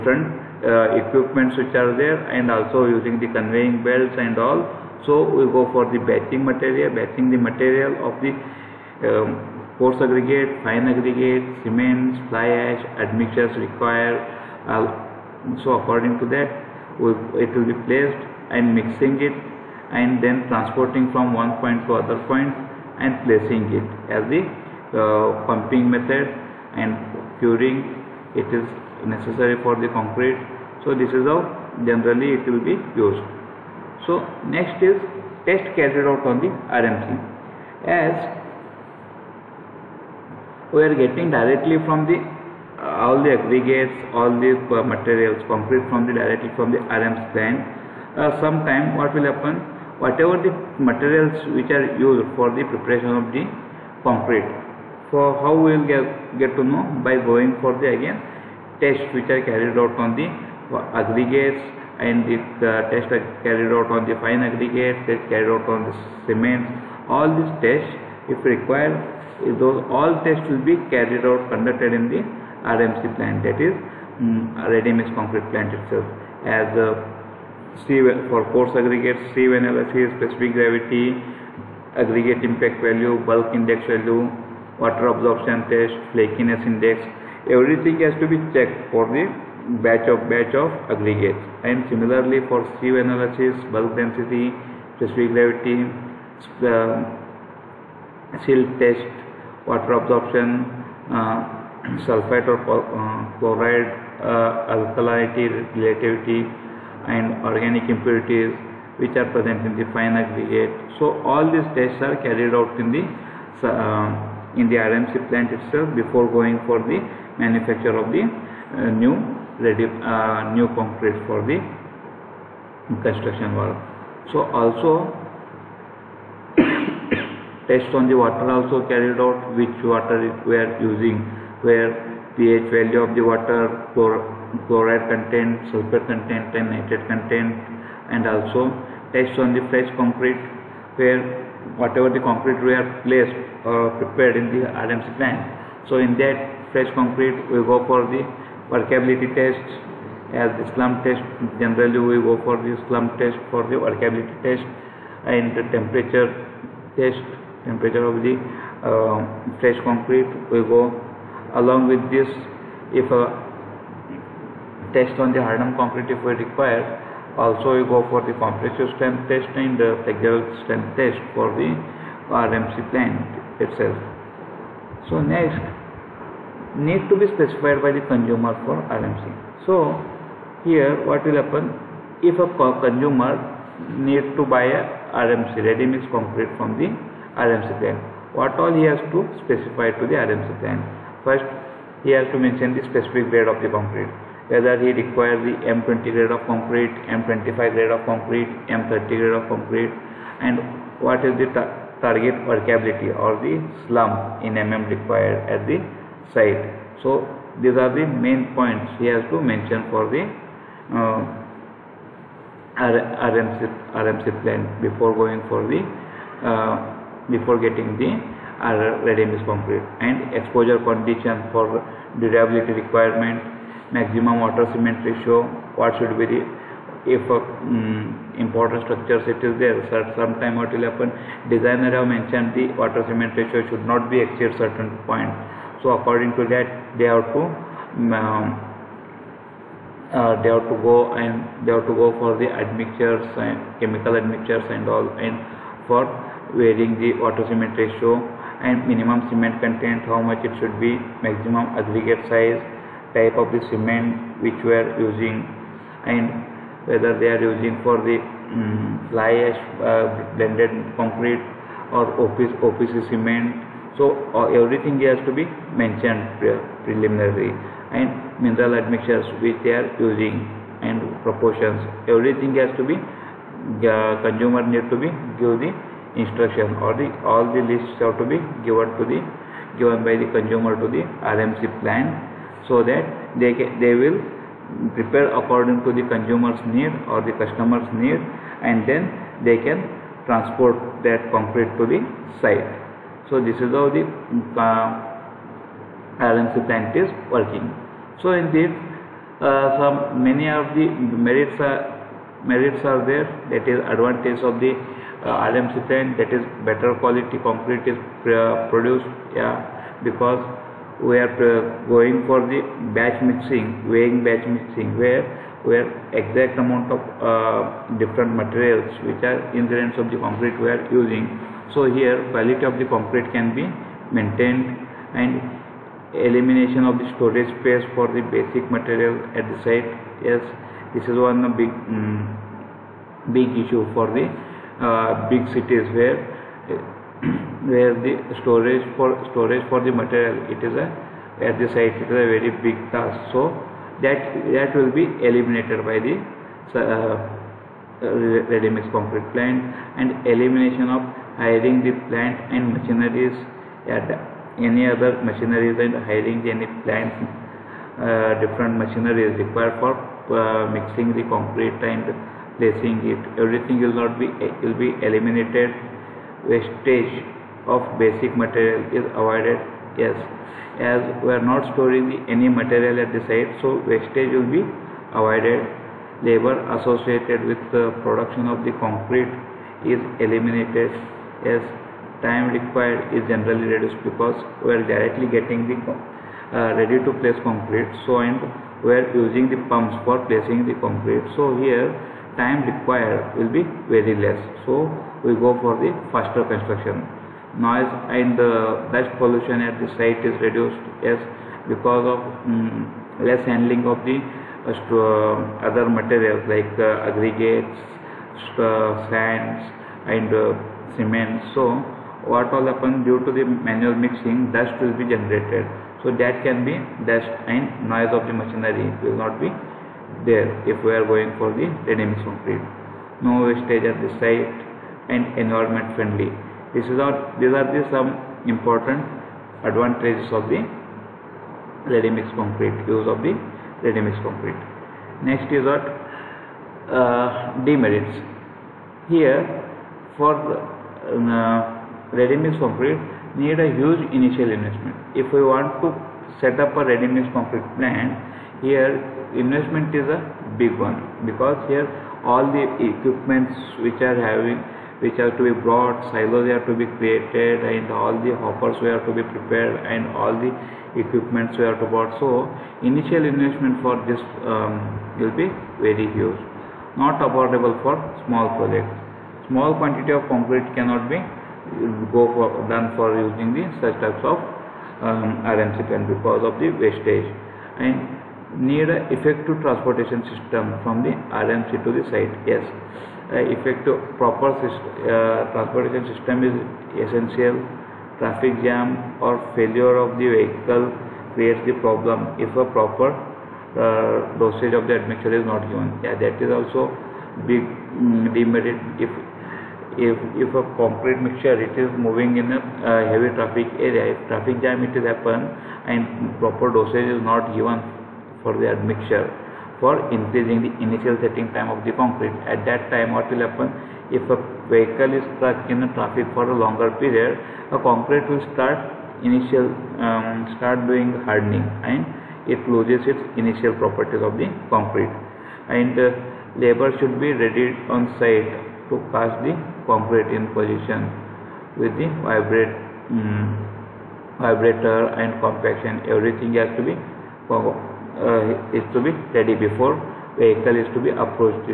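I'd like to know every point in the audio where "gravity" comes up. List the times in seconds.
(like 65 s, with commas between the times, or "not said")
80 s, 95 s.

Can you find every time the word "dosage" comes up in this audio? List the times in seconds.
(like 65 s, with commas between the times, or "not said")
494 s, 506 s.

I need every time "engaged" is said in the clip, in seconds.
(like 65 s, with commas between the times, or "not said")
not said.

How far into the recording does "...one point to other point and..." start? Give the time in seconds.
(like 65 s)
21 s.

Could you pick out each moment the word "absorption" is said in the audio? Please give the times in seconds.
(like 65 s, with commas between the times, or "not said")
85 s, 100 s.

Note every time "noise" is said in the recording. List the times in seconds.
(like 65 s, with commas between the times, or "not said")
397 s, 417 s.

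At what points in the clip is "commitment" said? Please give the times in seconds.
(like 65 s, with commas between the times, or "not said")
not said.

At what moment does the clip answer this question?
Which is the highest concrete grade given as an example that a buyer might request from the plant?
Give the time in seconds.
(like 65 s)
198 s.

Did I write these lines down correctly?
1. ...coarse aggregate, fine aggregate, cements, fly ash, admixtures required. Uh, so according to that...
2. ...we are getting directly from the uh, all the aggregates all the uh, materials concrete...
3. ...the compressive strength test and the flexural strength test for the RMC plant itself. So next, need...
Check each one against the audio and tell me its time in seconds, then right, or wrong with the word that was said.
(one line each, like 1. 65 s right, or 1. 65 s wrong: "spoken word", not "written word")
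1. 9 s right
2. 40 s right
3. 168 s right.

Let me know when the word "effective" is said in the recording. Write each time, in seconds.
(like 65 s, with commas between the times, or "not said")
479 s, 483 s.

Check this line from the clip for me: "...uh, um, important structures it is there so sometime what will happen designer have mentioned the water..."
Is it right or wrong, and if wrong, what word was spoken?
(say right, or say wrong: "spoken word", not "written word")
right.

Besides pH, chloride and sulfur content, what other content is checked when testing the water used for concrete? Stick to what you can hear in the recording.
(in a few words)
Nitrate content.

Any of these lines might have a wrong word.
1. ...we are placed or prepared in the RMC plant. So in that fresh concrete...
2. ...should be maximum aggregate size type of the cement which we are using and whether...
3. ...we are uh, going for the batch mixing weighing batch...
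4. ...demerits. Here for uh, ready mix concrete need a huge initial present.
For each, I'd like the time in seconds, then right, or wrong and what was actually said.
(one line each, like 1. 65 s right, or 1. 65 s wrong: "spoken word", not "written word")
1. 142 s right
2. 250 s right
3. 311 s right
4. 437 s wrong: "investment", not "present".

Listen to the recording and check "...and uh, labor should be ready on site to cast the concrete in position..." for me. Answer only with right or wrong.
right.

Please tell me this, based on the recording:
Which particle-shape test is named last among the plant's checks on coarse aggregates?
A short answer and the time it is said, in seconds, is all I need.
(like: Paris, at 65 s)
Flakiness index, at 86 s.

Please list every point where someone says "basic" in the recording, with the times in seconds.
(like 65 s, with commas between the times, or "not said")
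328 s, 367 s.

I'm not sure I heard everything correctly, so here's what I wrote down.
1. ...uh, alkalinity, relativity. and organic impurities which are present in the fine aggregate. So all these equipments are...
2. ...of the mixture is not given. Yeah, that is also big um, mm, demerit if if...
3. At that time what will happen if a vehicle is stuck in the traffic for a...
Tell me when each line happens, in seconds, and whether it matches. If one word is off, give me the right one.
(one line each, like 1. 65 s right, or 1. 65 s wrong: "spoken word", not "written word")
1. 104 s wrong: "tests", not "equipments"
2. 494 s wrong: "admixture", not "mixture"
3. 512 s right.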